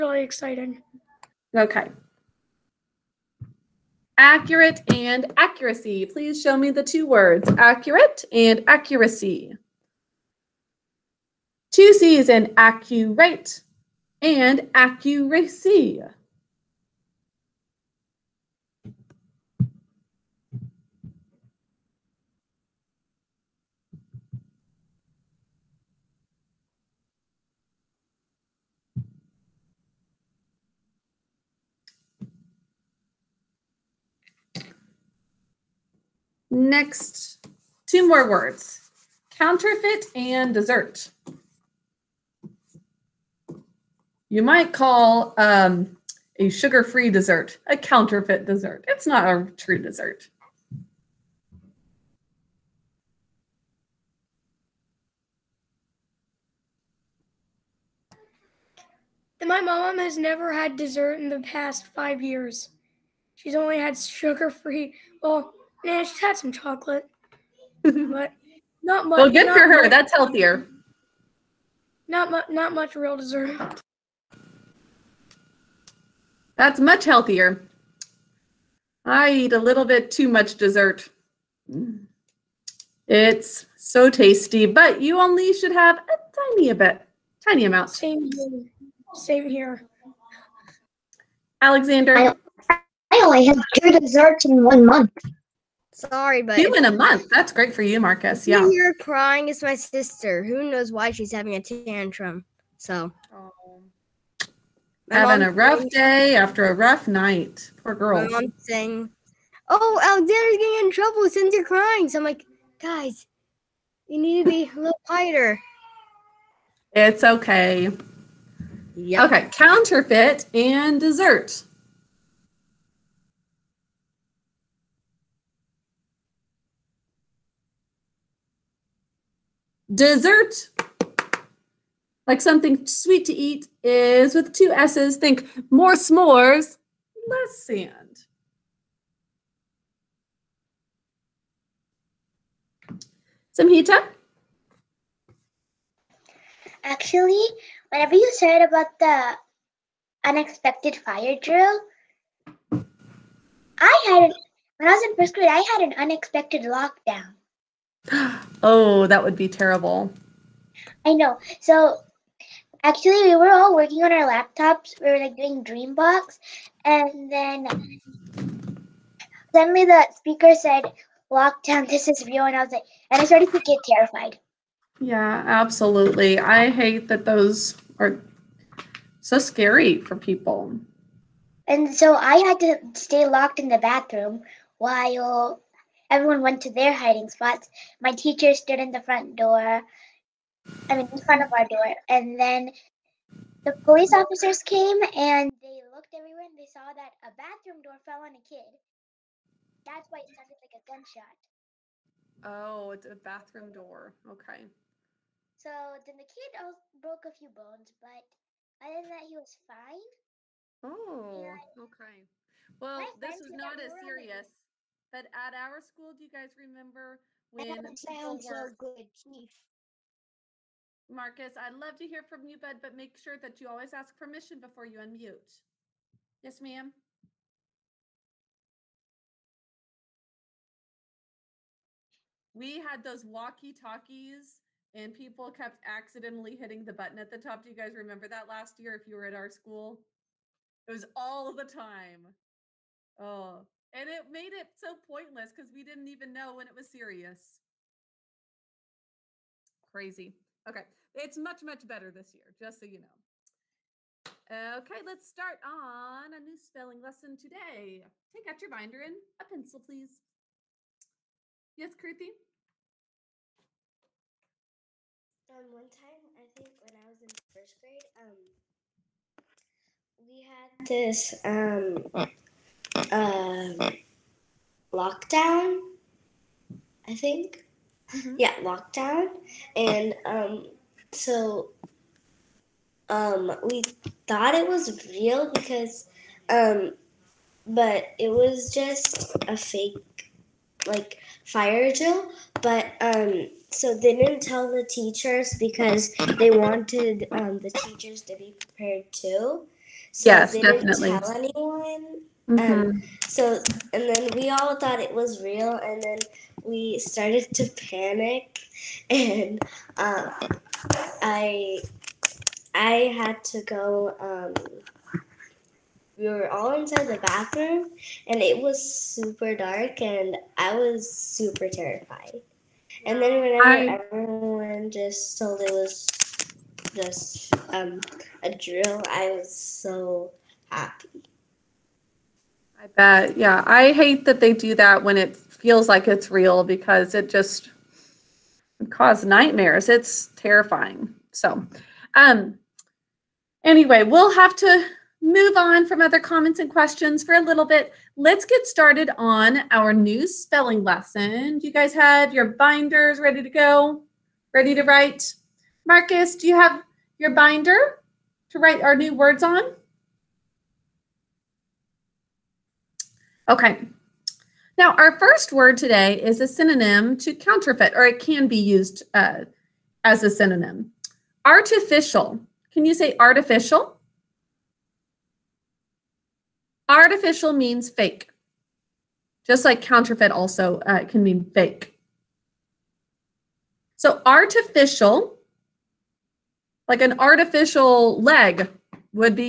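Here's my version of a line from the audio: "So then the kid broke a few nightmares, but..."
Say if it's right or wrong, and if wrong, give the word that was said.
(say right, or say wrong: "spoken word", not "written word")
wrong: "bones", not "nightmares".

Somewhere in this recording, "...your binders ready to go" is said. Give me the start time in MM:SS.
05:52.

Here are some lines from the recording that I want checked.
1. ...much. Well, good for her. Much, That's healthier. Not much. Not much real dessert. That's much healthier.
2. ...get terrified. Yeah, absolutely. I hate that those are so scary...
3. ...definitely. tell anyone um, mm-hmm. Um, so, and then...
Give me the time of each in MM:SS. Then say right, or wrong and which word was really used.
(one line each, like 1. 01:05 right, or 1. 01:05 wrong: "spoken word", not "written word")
1. 01:09 right
2. 02:53 right
3. 05:00 right.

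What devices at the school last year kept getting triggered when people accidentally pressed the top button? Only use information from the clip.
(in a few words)
walkie talkies.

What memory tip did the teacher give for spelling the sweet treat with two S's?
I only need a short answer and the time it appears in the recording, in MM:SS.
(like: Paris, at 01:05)
more s'mores, less sand, at 02:15.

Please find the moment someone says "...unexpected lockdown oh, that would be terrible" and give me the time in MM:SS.
02:35.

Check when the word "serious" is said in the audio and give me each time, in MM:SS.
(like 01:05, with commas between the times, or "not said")
03:34, 04:06.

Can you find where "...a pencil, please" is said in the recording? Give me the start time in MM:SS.
04:19.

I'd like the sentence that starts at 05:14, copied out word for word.
Um, we were all inside the bathroom, and it was super dark, and I was super terrified.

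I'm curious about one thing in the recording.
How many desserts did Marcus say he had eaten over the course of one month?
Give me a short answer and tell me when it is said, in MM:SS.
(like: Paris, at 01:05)
2, at 01:33.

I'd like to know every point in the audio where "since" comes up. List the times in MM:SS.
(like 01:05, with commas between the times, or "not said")
01:51.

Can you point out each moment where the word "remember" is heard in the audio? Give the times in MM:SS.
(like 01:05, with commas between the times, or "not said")
03:36, 03:57.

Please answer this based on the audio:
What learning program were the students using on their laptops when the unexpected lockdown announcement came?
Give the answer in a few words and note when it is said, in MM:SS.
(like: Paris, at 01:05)
Dreambox, at 02:45.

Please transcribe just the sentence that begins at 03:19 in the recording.
That's why it sounded like a gunshot.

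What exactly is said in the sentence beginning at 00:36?
Next, two more words, counterfeit and dessert.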